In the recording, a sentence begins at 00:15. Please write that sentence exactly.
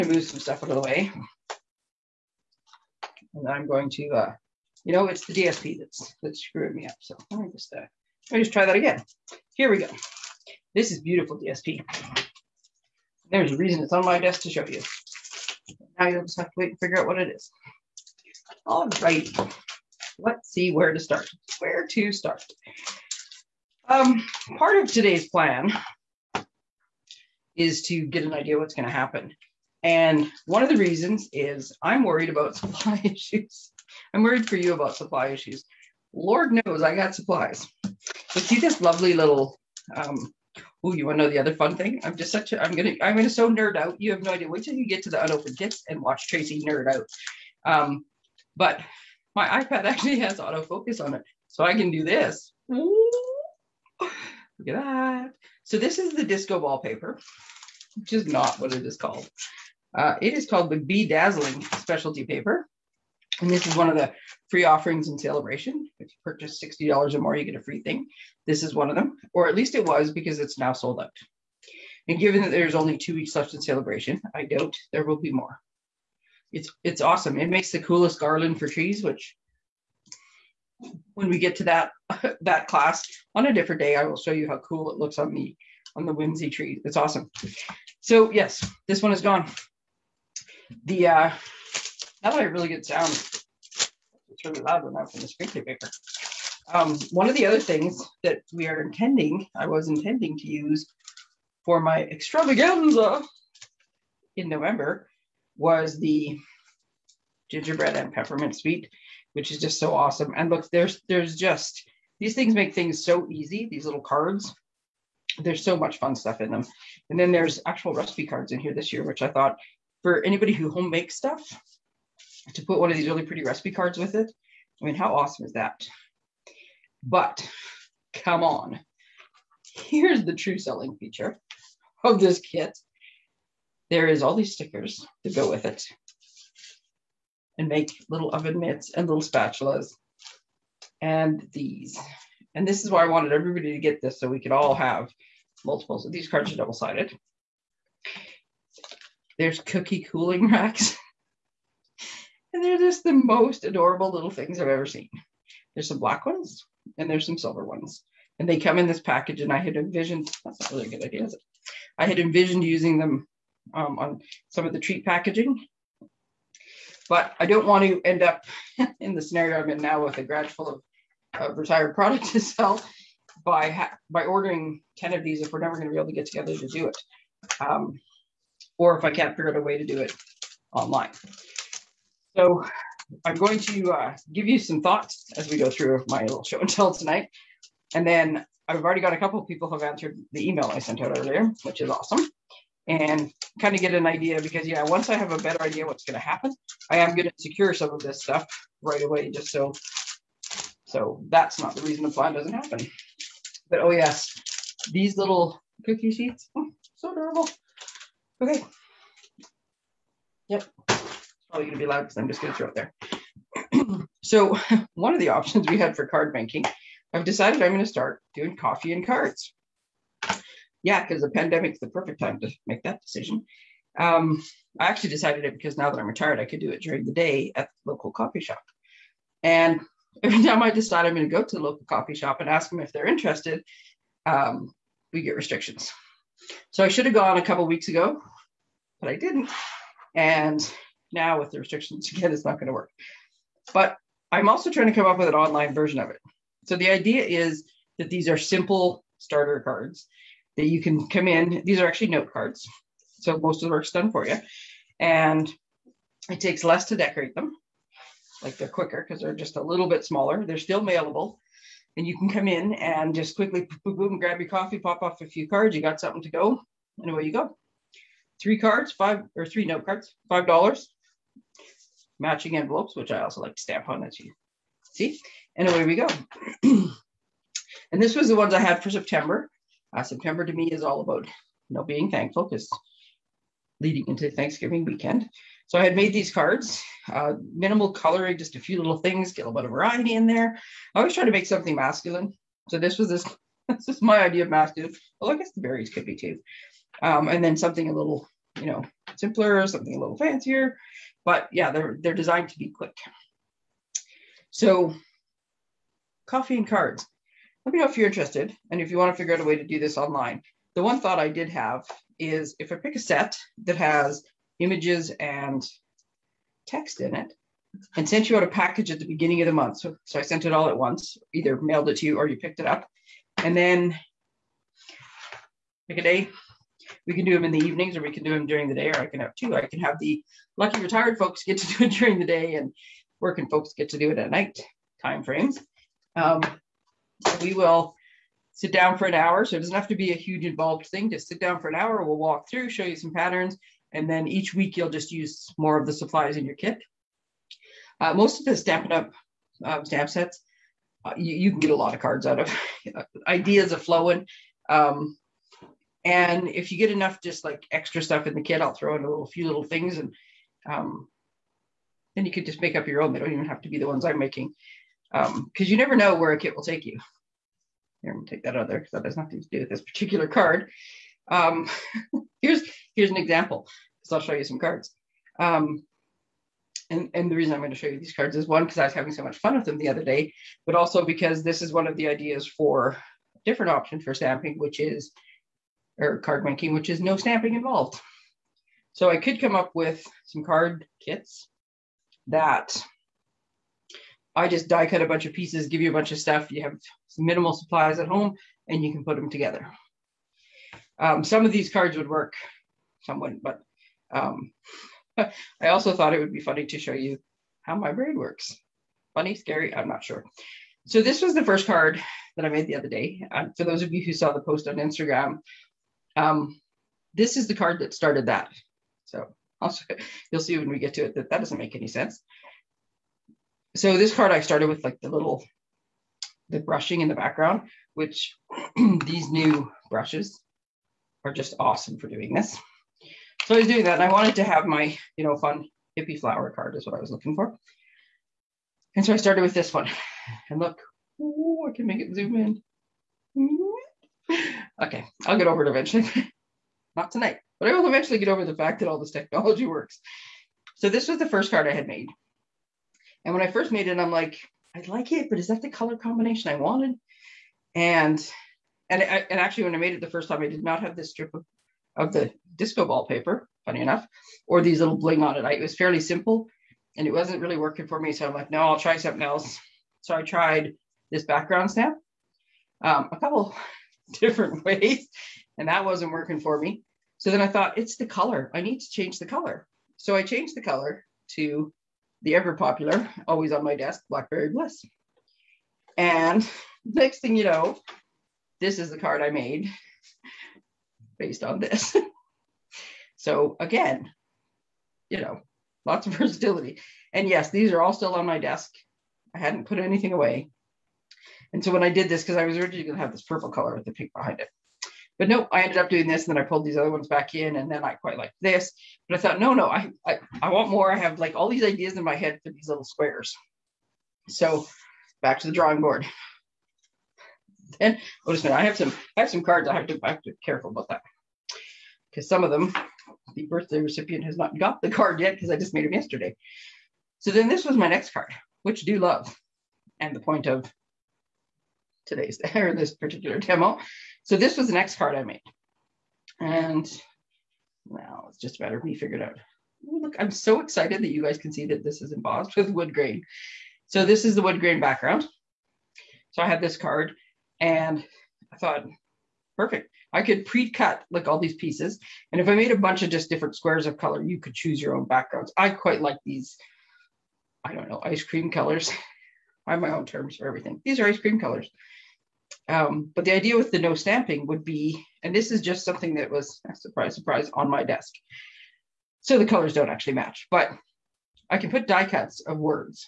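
Now you'll just have to wait and figure out what it is.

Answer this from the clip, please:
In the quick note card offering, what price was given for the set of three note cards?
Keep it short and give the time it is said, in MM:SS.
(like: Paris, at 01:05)
5 dollars, at 04:30.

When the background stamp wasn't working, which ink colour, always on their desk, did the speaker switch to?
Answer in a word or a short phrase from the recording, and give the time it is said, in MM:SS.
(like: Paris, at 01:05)
Blackberry Bliss, at 08:04.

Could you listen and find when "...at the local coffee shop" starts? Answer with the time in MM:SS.
03:47.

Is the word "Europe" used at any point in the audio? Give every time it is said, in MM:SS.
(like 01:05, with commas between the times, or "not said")
not said.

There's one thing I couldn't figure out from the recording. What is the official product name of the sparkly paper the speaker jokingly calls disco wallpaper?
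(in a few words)
Bedazzling Specialty Paper.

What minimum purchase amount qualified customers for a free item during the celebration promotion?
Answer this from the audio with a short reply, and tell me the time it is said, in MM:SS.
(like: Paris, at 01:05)
$60, at 01:06.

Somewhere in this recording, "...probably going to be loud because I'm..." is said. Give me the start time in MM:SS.
03:31.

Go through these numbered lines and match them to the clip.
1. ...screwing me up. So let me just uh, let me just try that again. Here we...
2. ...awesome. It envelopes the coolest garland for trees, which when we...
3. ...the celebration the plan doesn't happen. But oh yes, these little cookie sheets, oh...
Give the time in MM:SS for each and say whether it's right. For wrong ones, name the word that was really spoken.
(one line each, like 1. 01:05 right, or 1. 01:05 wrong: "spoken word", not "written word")
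1. 00:06 right
2. 01:17 wrong: "makes", not "envelopes"
3. 03:21 wrong: "reason", not "celebration".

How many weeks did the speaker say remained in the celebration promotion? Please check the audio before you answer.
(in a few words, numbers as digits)
2.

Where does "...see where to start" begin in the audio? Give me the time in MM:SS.
00:20.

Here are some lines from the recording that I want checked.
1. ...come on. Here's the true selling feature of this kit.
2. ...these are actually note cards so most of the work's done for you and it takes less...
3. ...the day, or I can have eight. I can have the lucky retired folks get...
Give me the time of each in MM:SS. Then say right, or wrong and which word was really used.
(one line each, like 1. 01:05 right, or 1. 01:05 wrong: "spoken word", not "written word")
1. 02:08 right
2. 04:11 right
3. 05:28 wrong: "two", not "eight".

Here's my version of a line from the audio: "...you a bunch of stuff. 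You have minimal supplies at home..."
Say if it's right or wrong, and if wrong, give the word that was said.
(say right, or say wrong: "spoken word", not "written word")
right.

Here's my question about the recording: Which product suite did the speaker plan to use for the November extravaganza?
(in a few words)
gingerbread and peppermint.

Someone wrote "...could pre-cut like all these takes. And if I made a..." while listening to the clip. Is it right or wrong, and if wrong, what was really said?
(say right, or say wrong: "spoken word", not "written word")
wrong: "pieces", not "takes".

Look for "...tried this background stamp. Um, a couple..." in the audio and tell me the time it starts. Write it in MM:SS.
07:50.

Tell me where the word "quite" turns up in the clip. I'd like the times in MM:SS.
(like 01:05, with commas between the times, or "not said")
08:27, 09:15.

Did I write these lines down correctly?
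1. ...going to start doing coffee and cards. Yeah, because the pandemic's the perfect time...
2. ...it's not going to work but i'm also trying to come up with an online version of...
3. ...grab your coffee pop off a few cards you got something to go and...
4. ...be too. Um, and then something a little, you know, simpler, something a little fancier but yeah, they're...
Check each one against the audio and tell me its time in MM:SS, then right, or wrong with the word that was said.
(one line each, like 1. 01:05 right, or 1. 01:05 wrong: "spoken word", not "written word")
1. 03:37 right
2. 04:02 right
3. 04:24 right
4. 04:56 right.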